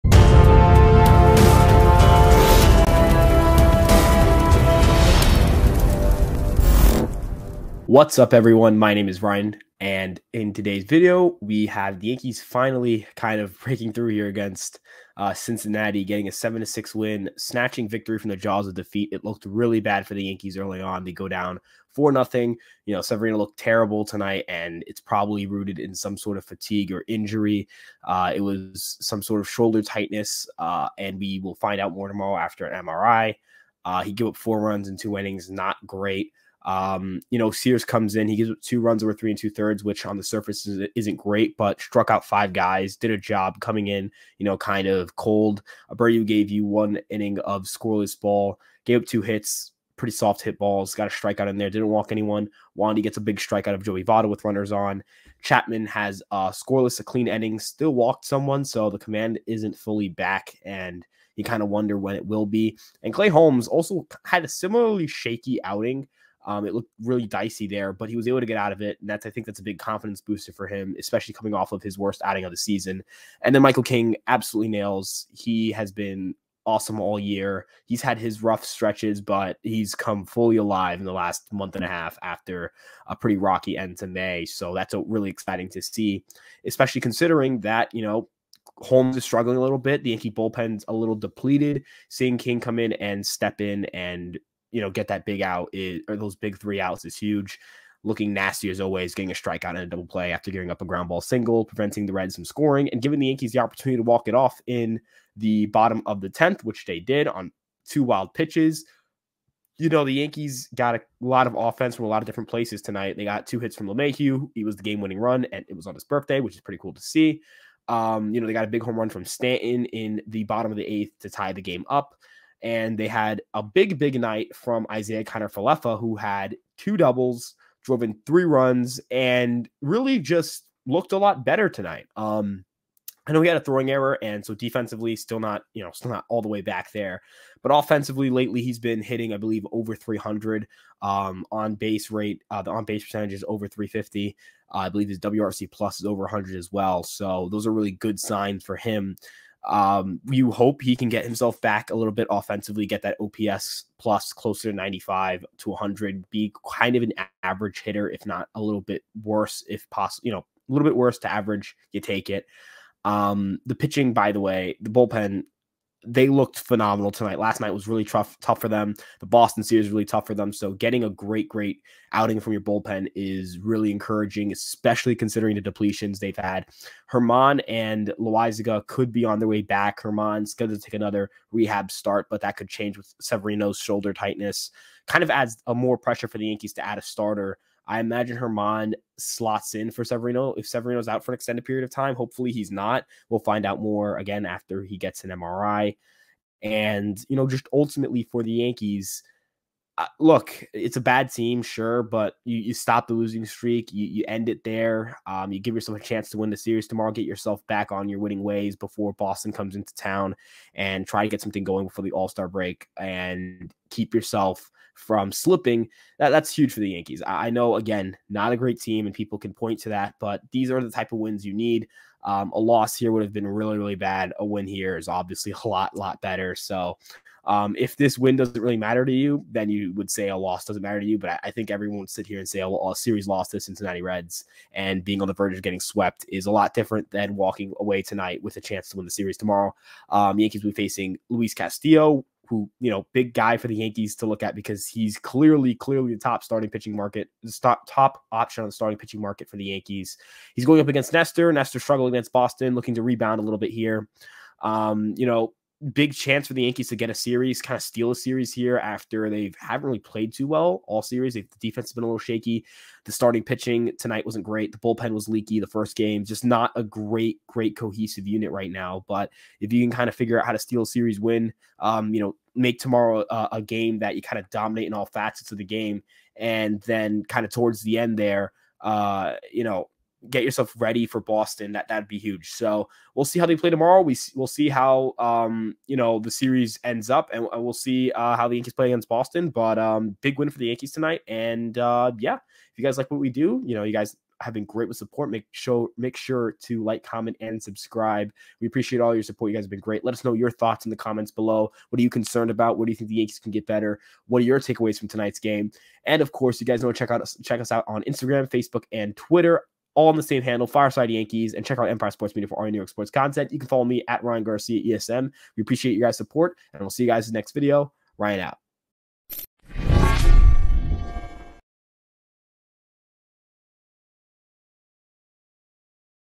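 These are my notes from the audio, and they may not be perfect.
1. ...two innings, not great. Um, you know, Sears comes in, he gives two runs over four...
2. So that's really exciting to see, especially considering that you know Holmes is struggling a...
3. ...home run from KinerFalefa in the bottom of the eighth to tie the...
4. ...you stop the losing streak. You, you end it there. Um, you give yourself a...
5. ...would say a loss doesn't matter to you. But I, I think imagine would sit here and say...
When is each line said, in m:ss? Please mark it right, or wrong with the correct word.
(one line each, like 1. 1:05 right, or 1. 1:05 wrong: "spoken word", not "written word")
1. 0:34 wrong: "three", not "four"
2. 1:24 right
3. 1:58 wrong: "Stanton", not "KinerFalefa"
4. 3:22 right
5. 3:49 wrong: "everyone", not "imagine".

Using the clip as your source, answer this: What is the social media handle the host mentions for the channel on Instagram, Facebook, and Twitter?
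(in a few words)
Fireside Yankees.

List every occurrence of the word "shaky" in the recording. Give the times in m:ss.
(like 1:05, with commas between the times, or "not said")
1:05, 4:22.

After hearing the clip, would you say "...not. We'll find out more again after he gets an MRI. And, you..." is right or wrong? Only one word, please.
right.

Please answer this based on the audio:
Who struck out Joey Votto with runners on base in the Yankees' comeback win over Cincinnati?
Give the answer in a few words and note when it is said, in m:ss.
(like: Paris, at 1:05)
Wandy, at 0:52.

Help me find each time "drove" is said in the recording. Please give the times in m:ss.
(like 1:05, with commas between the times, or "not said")
2:07.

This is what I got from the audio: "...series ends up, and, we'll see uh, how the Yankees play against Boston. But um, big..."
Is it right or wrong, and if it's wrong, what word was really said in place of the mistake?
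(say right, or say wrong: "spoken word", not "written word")
right.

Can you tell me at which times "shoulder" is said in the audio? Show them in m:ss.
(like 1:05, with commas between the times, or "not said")
0:29, 3:03.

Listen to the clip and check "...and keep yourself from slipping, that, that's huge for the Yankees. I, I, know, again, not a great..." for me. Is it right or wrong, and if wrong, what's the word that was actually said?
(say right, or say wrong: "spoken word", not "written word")
right.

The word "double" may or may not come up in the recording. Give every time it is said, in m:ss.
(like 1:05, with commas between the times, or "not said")
1:39, 2:06.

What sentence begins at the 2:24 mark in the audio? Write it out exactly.
Uh, I believe his WRC plus is over 100 as well.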